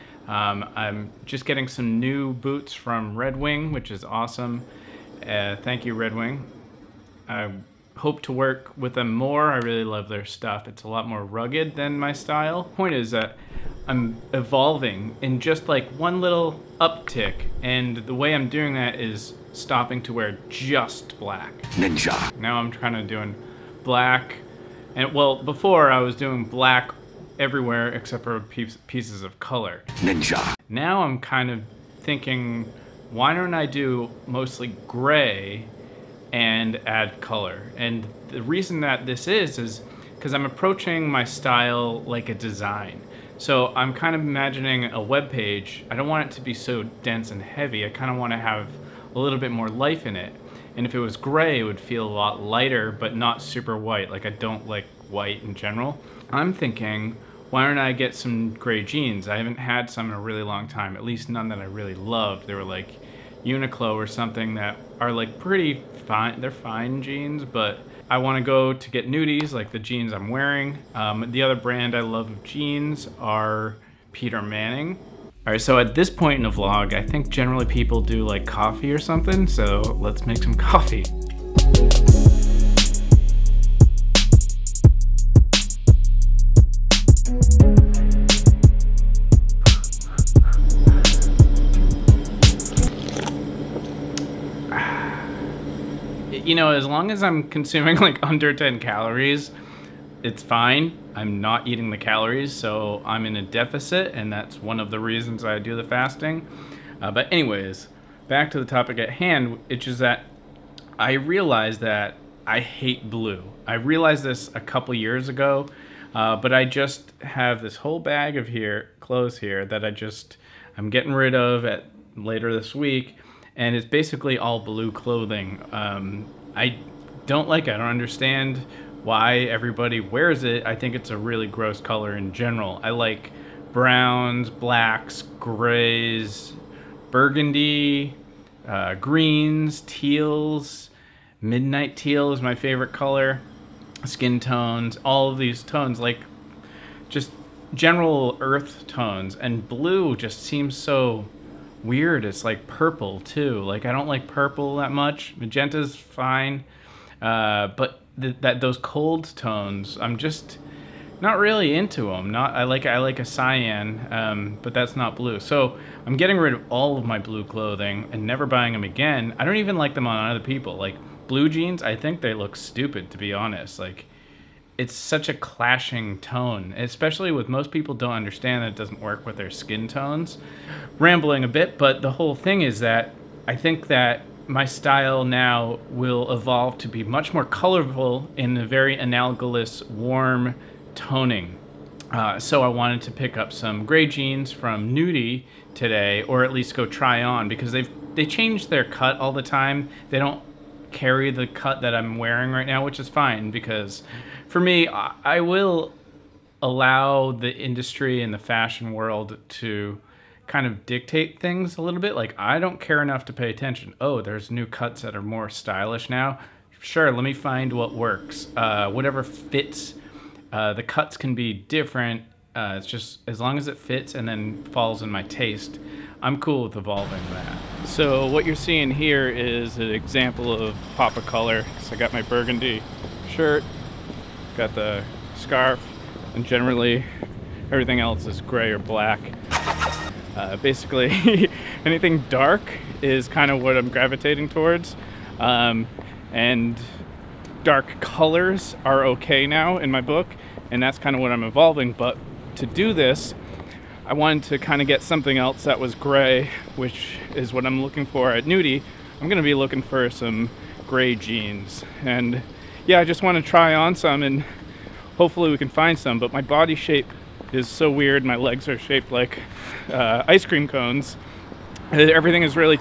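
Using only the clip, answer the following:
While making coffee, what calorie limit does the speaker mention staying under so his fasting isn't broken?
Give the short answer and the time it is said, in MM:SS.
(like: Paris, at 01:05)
10 calories, at 01:38.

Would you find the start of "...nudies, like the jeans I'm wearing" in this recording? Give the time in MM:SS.
01:09.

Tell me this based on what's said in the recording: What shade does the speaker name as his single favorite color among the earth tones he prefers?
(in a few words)
Midnight teal.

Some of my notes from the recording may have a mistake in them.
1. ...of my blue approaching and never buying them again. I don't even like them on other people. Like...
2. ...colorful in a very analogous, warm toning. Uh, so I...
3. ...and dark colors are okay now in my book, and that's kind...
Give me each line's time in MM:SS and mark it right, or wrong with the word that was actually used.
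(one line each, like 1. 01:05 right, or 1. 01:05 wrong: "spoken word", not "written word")
1. 02:46 wrong: "clothing", not "approaching"
2. 03:07 right
3. 04:06 right.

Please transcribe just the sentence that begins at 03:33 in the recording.
Oh, there's new cuts that are more stylish now.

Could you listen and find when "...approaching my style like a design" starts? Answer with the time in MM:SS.
00:40.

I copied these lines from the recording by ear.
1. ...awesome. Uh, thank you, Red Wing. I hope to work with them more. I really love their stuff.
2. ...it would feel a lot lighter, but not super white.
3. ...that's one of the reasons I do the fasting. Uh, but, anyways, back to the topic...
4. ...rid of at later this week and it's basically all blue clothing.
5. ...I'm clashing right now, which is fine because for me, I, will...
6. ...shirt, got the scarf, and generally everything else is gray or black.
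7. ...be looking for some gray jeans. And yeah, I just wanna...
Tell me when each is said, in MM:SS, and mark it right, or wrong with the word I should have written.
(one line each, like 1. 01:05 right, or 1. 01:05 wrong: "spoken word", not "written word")
1. 00:04 right
2. 00:51 right
3. 01:44 right
4. 02:01 right
5. 03:21 wrong: "wearing", not "clashing"
6. 03:53 right
7. 04:19 right.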